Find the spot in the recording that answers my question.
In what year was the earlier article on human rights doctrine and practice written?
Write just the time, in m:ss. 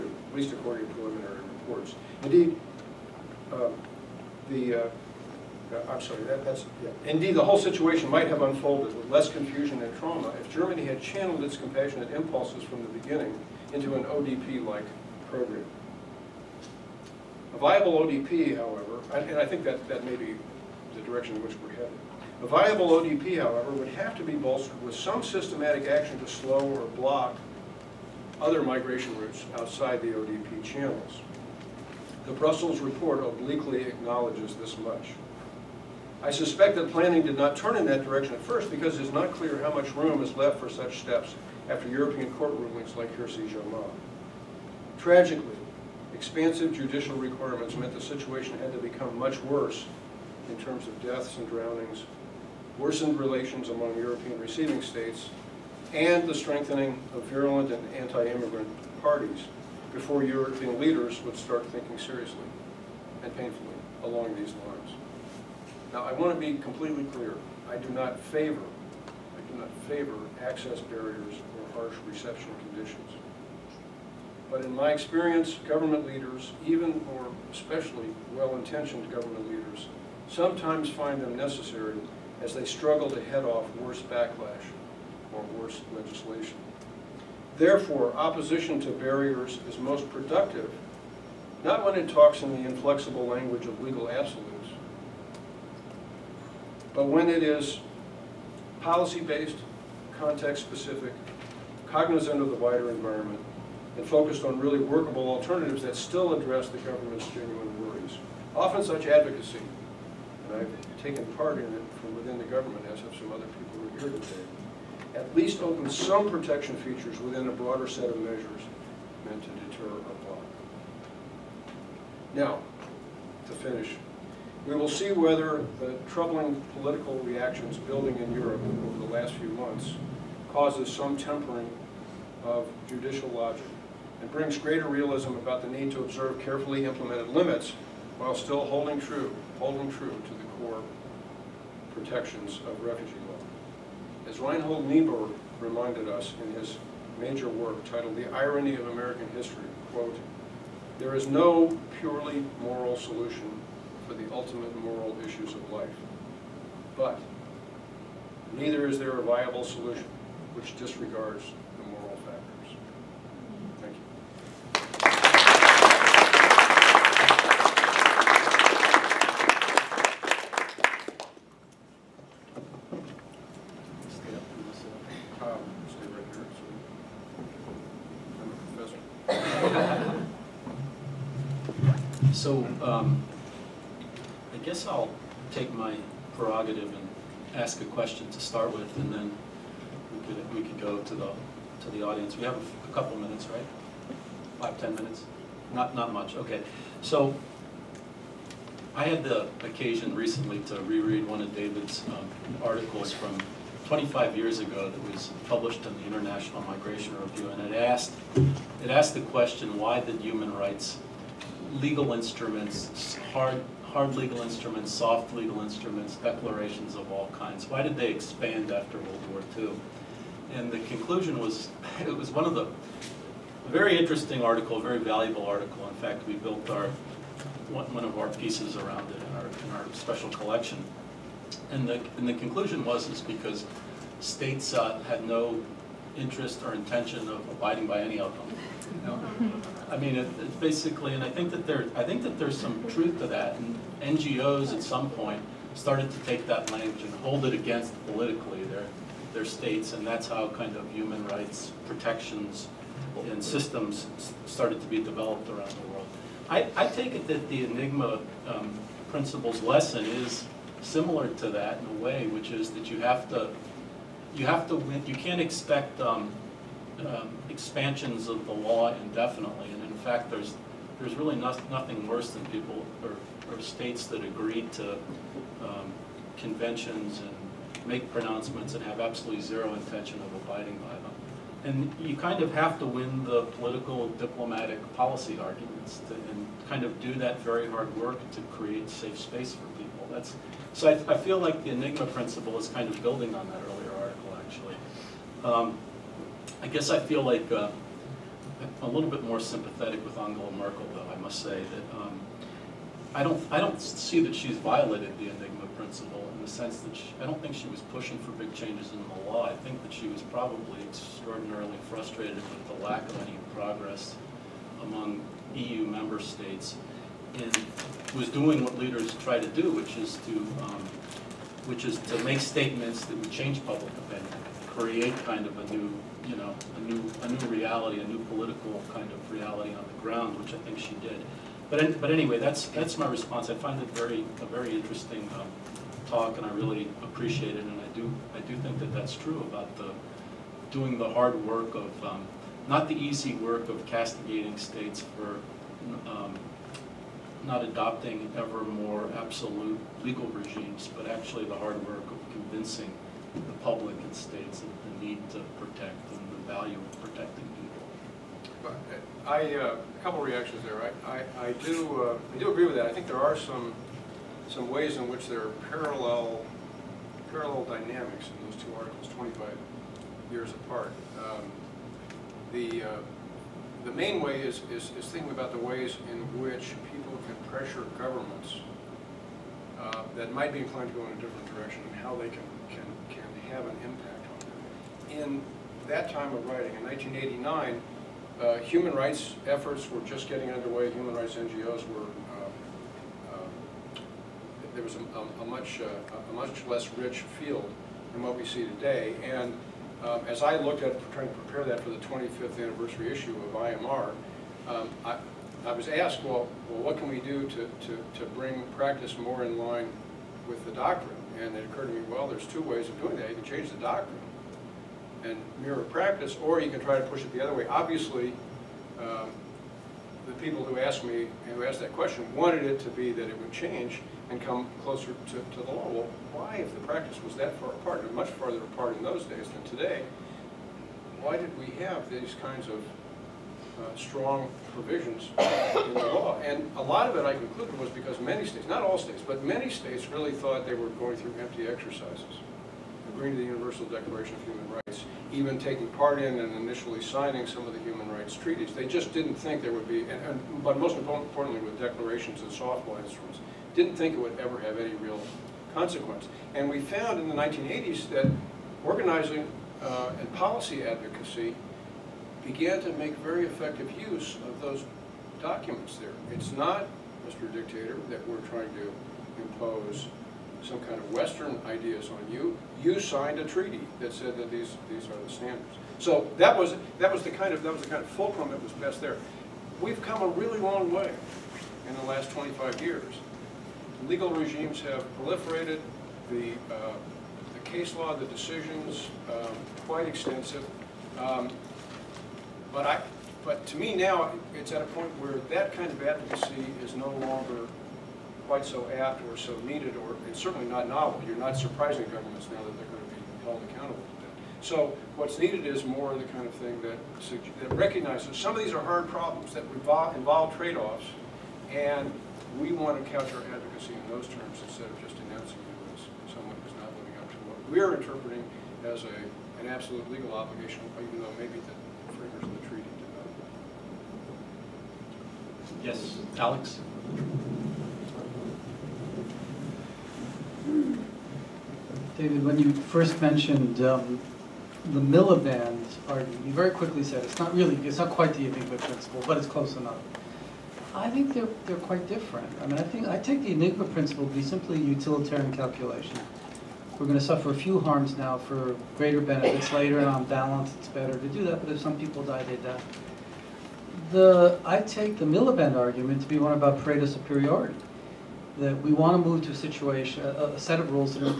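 6:26.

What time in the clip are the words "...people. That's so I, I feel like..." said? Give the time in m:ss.
4:49.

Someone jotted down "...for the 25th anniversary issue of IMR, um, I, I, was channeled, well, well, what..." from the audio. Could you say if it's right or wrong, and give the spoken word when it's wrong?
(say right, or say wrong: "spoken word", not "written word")
wrong: "asked", not "channeled".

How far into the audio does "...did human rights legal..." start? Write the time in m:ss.
3:30.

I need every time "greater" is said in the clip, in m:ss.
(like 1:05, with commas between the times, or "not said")
2:14, 9:08.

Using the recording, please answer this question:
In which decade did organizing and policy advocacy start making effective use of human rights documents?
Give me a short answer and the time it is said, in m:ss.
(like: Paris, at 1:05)
1980s, at 7:37.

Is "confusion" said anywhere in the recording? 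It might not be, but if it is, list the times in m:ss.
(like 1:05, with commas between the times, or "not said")
0:09.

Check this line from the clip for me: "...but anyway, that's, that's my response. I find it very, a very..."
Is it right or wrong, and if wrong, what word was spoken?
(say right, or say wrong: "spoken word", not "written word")
right.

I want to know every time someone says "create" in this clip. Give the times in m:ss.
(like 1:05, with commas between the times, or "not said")
4:48, 5:24.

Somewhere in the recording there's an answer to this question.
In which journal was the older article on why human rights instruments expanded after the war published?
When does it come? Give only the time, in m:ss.
3:26.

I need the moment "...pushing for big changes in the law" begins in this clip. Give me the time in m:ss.
5:07.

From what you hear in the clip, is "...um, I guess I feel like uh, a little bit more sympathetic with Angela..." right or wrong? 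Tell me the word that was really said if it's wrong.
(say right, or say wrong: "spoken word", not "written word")
right.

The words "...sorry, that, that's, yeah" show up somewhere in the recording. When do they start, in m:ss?
0:06.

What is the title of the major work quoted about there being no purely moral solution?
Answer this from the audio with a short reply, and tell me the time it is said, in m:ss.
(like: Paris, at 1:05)
The Irony of American History, at 2:28.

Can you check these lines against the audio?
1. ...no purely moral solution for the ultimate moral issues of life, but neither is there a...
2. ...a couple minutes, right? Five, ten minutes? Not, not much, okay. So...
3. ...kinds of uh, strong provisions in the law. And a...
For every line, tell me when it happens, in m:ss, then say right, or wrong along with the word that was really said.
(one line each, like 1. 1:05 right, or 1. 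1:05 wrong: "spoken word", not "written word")
1. 2:31 right
2. 3:12 right
3. 7:12 right.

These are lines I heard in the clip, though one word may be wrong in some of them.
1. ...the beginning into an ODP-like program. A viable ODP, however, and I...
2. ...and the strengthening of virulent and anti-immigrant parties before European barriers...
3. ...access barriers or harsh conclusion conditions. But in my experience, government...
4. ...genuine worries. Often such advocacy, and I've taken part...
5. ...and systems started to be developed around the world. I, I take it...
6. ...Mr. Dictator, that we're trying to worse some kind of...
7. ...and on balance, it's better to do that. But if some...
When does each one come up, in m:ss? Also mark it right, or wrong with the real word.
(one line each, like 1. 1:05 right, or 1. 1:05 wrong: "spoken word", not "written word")
1. 0:12 right
2. 0:55 wrong: "leaders", not "barriers"
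3. 1:10 wrong: "reception", not "conclusion"
4. 1:47 right
5. 4:13 right
6. 7:47 wrong: "impose", not "worse"
7. 9:10 right.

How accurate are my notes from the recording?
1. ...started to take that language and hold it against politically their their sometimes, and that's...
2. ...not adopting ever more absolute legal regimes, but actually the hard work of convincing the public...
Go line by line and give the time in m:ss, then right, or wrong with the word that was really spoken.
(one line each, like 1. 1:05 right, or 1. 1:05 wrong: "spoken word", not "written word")
1. 4:05 wrong: "states", not "sometimes"
2. 5:47 right.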